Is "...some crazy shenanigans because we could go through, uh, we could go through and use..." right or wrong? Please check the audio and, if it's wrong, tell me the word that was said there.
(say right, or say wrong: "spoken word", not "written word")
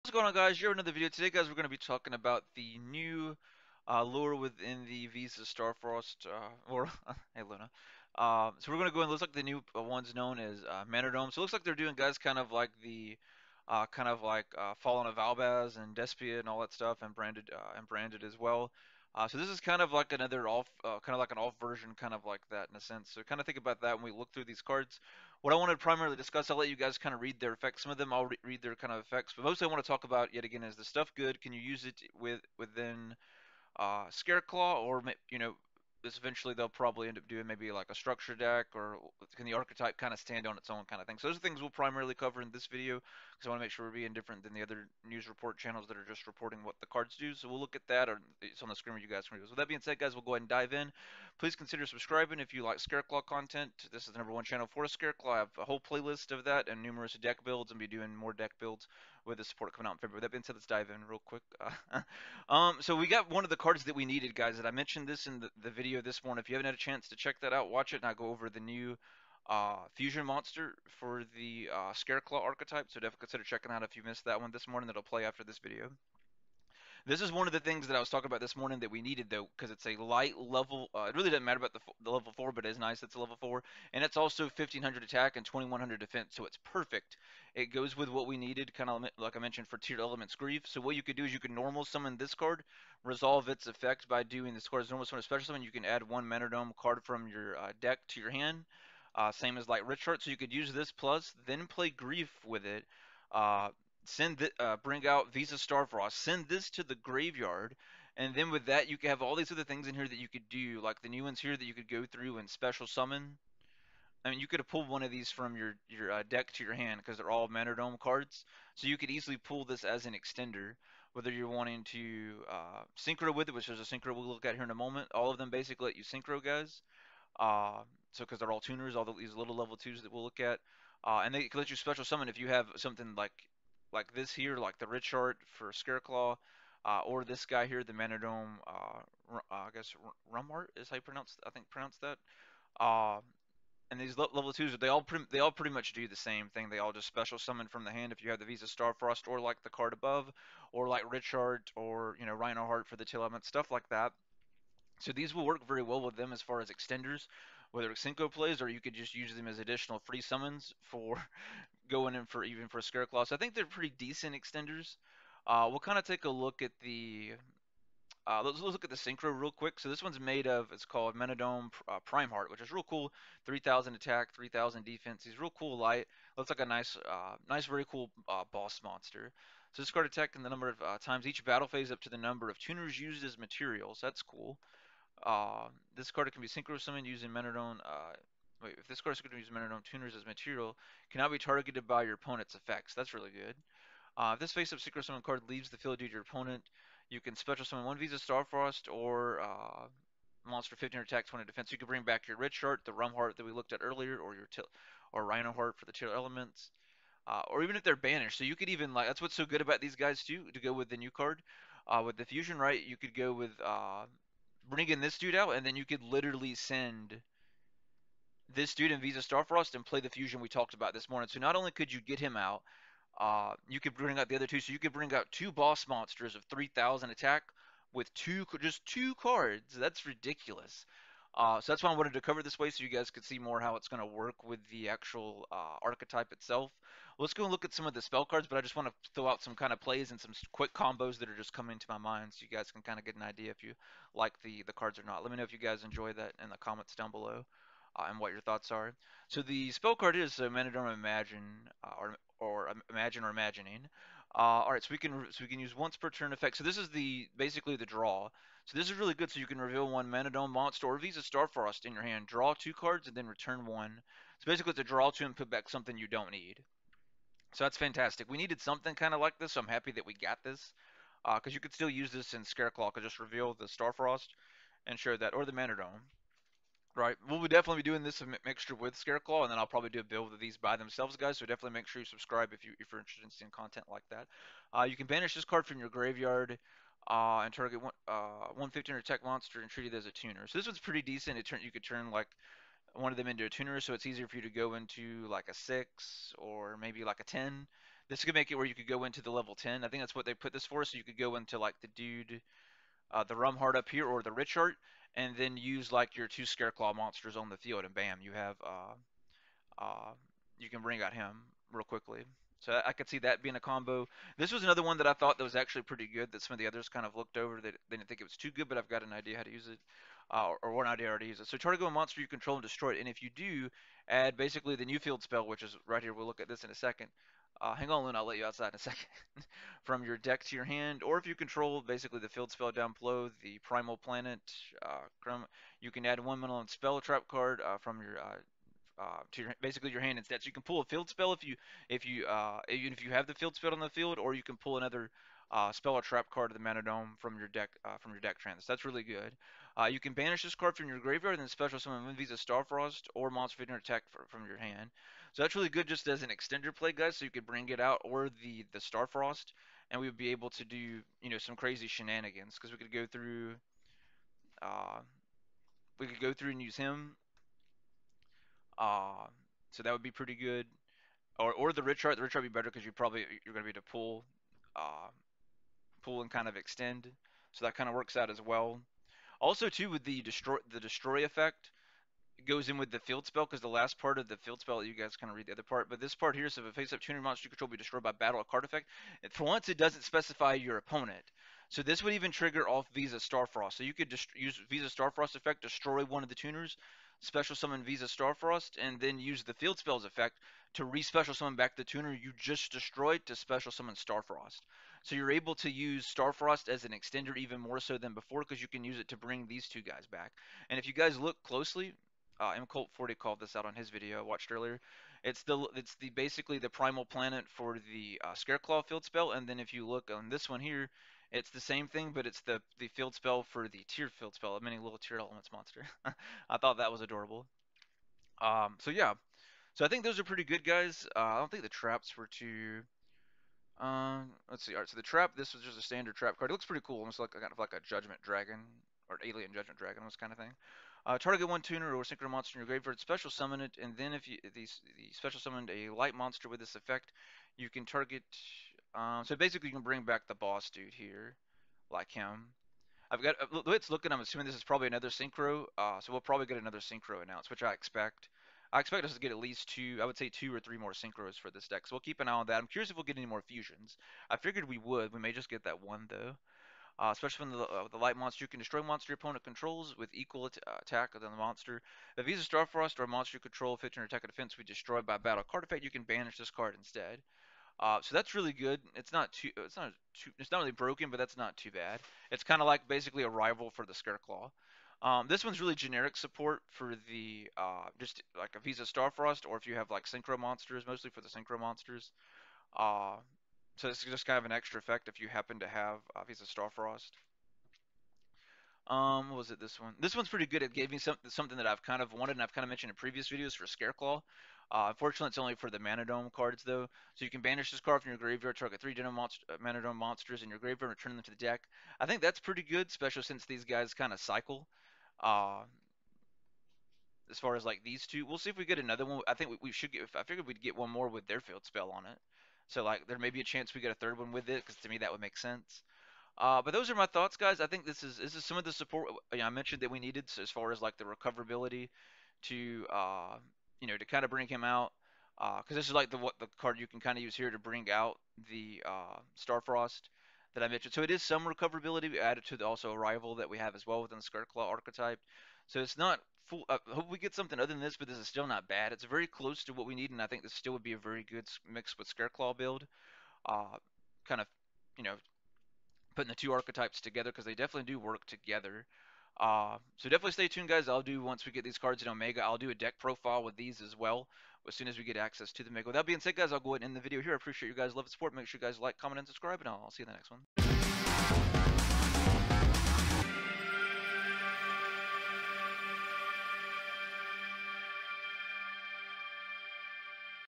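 right.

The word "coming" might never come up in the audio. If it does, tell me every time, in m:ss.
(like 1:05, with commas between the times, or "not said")
0:59, 4:01.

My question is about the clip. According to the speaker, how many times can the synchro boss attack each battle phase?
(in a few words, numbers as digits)
Number of tuners used as materials.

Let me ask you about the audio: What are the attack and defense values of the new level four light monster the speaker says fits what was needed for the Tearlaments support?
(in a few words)
1500 attack, 2100 defense.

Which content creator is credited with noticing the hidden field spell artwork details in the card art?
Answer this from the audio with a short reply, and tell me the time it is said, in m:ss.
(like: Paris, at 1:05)
MCult40, at 6:52.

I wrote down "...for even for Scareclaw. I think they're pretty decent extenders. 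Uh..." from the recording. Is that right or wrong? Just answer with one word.
right.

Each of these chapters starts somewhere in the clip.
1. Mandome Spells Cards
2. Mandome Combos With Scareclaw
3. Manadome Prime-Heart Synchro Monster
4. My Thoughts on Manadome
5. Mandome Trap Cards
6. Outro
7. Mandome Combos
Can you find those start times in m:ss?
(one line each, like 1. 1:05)
1. 4:09
2. 1:05
3. 2:50
4. 8:40
5. 7:15
6. 9:27
7. 6:20.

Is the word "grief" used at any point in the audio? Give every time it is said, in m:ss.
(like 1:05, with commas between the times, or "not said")
1:30, 1:41.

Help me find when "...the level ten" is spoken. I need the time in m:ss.
4:59.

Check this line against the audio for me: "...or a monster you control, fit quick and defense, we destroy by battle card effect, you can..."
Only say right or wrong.
wrong.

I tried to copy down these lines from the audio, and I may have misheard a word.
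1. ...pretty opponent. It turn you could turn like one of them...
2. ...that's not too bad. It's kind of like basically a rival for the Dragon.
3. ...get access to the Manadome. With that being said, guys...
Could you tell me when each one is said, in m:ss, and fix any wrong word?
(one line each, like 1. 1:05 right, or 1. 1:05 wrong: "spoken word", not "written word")
1. 4:50 wrong: "decent", not "opponent"
2. 8:01 wrong: "Scareclaw", not "Dragon"
3. 9:25 wrong: "Omega", not "Manadome".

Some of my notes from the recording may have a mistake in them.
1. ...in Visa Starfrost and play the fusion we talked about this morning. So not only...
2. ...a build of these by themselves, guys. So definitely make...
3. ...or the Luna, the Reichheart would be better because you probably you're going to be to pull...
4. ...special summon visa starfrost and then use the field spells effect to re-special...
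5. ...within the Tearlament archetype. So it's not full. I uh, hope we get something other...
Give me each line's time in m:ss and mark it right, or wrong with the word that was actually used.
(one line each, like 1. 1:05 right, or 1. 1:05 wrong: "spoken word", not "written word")
1. 3:38 right
2. 4:39 right
3. 6:11 wrong: "Reichheart", not "Luna"
4. 6:37 right
5. 9:04 wrong: "Scareclaw", not "Tearlament".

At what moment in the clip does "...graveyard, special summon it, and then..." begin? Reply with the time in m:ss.
7:22.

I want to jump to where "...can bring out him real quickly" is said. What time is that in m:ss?
5:10.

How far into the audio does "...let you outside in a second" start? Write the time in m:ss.
5:28.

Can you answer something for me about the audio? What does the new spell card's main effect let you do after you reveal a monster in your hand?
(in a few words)
Draw 2 cards.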